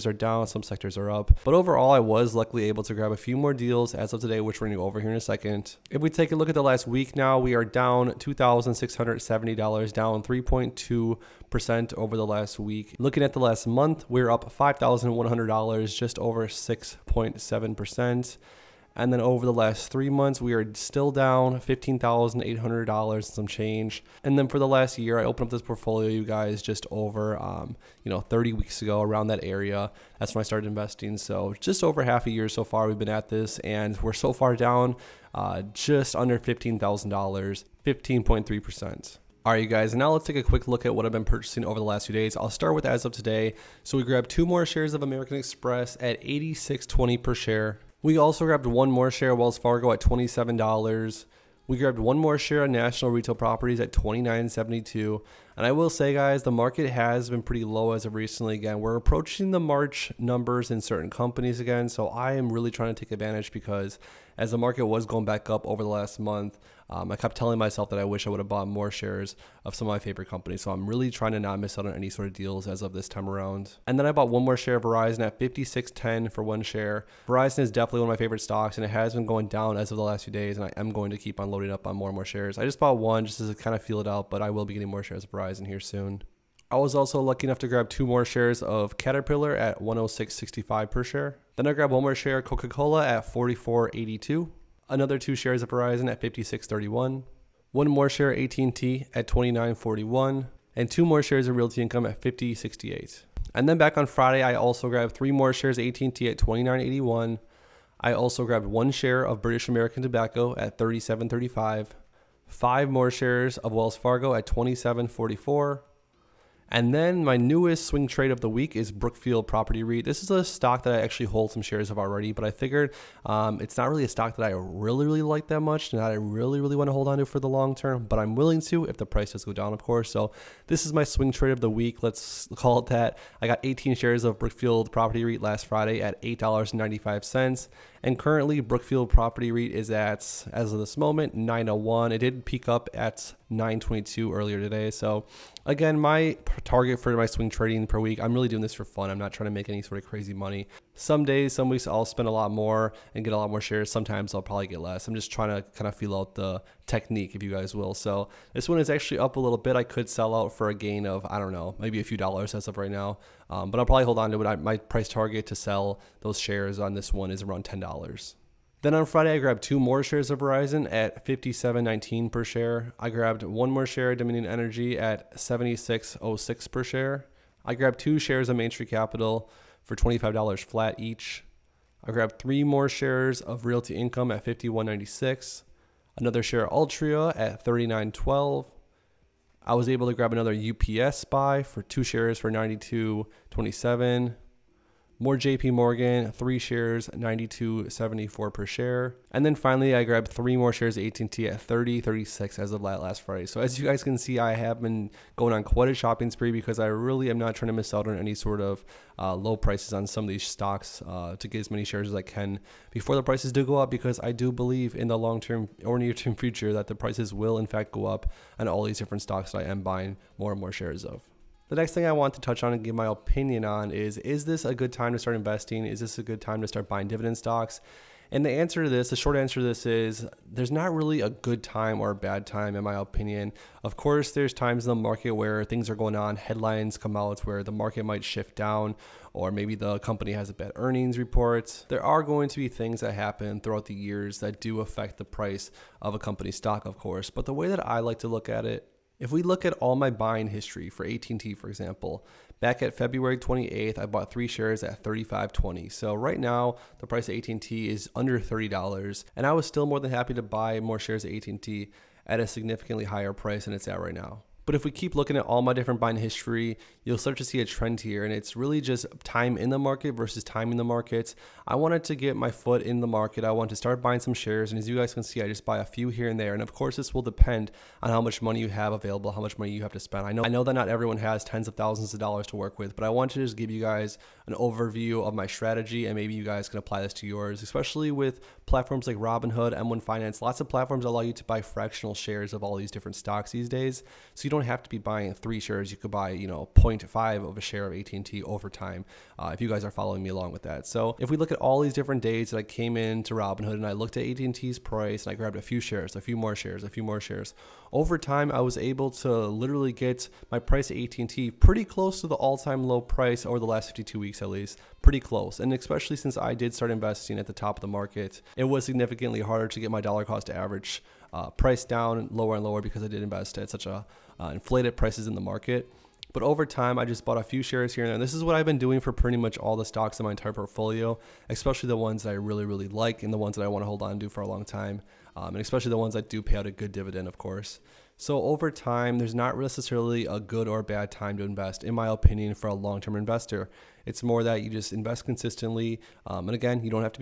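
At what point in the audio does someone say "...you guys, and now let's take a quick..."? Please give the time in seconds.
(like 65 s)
39 s.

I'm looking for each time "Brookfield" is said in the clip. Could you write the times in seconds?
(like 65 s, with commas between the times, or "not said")
118 s, 134 s, 138 s.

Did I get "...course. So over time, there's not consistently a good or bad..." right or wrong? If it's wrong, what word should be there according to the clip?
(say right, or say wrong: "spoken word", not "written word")
wrong: "necessarily", not "consistently".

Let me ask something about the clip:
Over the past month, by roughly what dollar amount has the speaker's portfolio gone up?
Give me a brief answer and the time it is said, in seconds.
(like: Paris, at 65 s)
$5,100, at 14 s.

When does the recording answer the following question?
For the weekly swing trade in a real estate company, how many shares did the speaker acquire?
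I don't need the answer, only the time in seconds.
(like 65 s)
133 s.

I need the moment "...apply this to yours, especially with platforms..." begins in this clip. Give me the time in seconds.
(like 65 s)
286 s.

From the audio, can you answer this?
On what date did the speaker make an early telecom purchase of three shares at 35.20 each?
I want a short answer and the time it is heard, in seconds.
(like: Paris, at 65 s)
February 28th, at 252 s.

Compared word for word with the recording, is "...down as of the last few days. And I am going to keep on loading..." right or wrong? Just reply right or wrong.
right.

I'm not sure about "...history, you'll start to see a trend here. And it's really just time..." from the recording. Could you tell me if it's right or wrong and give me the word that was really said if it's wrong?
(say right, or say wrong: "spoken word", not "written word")
right.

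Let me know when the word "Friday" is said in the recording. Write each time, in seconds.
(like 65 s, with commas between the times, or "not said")
104 s, 135 s, 169 s, 203 s.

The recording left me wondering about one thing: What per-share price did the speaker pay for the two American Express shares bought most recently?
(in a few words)
86.20.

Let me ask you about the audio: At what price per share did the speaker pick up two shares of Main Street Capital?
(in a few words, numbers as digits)
$25.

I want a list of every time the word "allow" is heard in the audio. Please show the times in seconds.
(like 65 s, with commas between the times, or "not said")
291 s.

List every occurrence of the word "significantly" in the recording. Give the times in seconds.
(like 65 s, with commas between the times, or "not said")
262 s, 318 s.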